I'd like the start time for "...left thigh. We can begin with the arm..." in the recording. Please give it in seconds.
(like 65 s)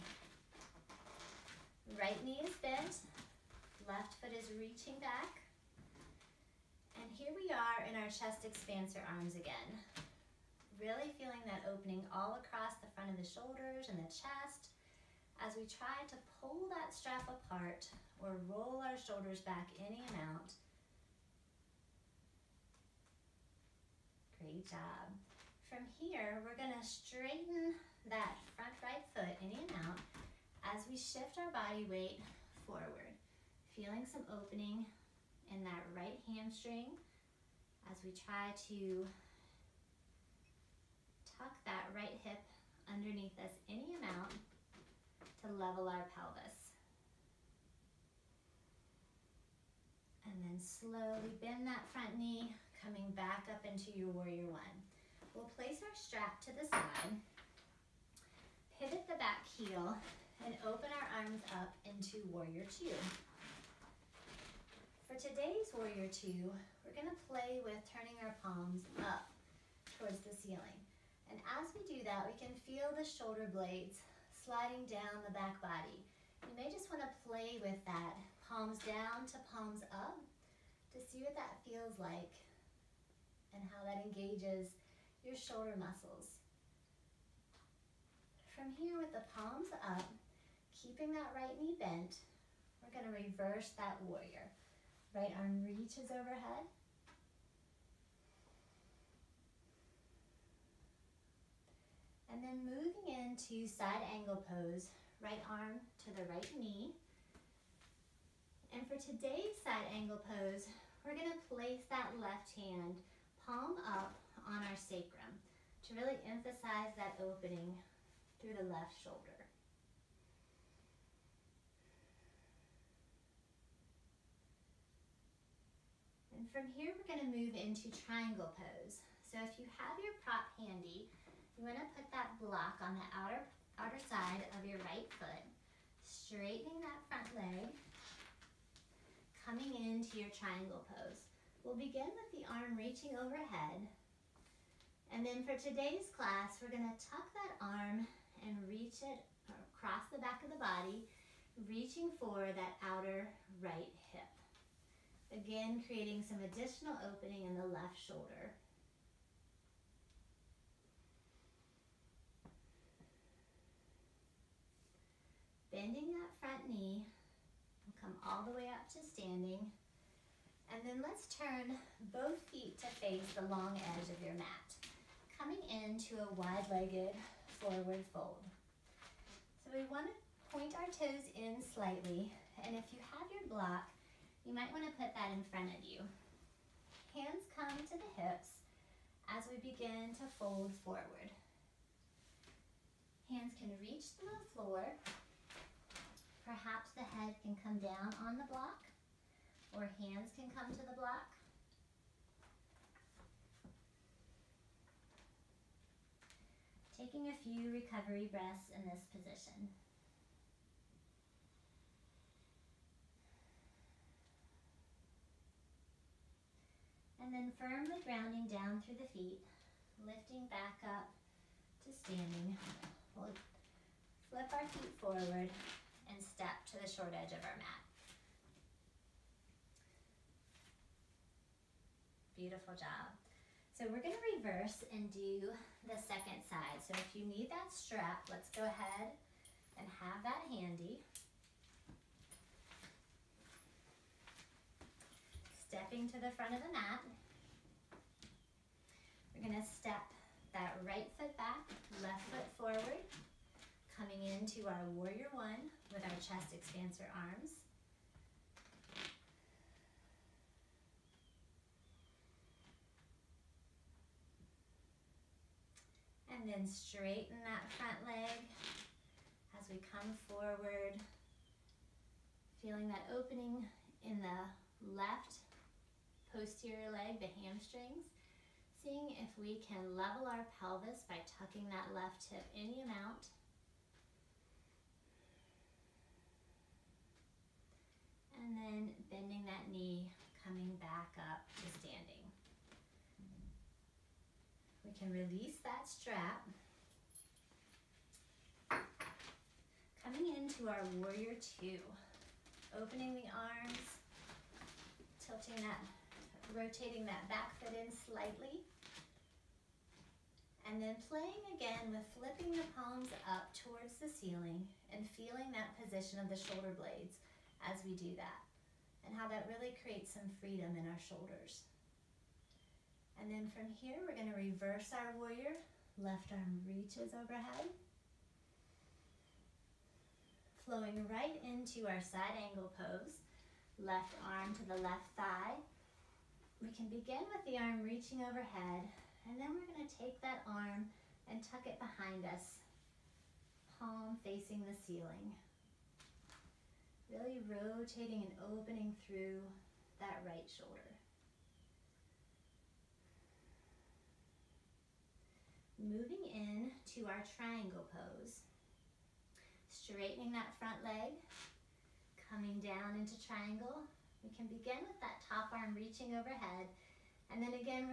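334 s.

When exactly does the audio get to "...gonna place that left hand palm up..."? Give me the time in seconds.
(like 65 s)
111 s.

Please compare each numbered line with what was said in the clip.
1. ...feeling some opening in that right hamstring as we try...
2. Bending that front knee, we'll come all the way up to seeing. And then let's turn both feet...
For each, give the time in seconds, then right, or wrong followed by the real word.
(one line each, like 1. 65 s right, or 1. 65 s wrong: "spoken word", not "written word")
1. 33 s right
2. 165 s wrong: "standing", not "seeing".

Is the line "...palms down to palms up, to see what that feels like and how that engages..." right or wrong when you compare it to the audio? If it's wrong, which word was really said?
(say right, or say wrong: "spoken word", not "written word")
right.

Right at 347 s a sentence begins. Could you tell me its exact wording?
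Really rotating and opening through that right shoulder.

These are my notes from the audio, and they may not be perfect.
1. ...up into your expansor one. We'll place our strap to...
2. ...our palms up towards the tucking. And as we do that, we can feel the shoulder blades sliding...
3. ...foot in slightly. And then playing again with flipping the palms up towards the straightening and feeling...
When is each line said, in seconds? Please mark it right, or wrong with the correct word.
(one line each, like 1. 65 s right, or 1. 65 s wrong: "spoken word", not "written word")
1. 53 s wrong: "warrior", not "expansor"
2. 68 s wrong: "ceiling", not "tucking"
3. 307 s wrong: "ceiling", not "straightening".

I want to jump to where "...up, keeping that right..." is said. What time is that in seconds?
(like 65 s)
89 s.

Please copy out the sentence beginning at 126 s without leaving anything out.
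And from here, we're gonna move into triangle pose.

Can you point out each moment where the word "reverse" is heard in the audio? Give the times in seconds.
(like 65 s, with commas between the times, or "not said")
93 s, 234 s, 324 s.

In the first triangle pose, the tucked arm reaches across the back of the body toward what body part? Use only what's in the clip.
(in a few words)
Outer right hip.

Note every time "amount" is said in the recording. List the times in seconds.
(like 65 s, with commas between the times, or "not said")
20 s, 44 s, 282 s.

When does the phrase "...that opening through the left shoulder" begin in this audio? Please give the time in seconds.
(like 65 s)
117 s.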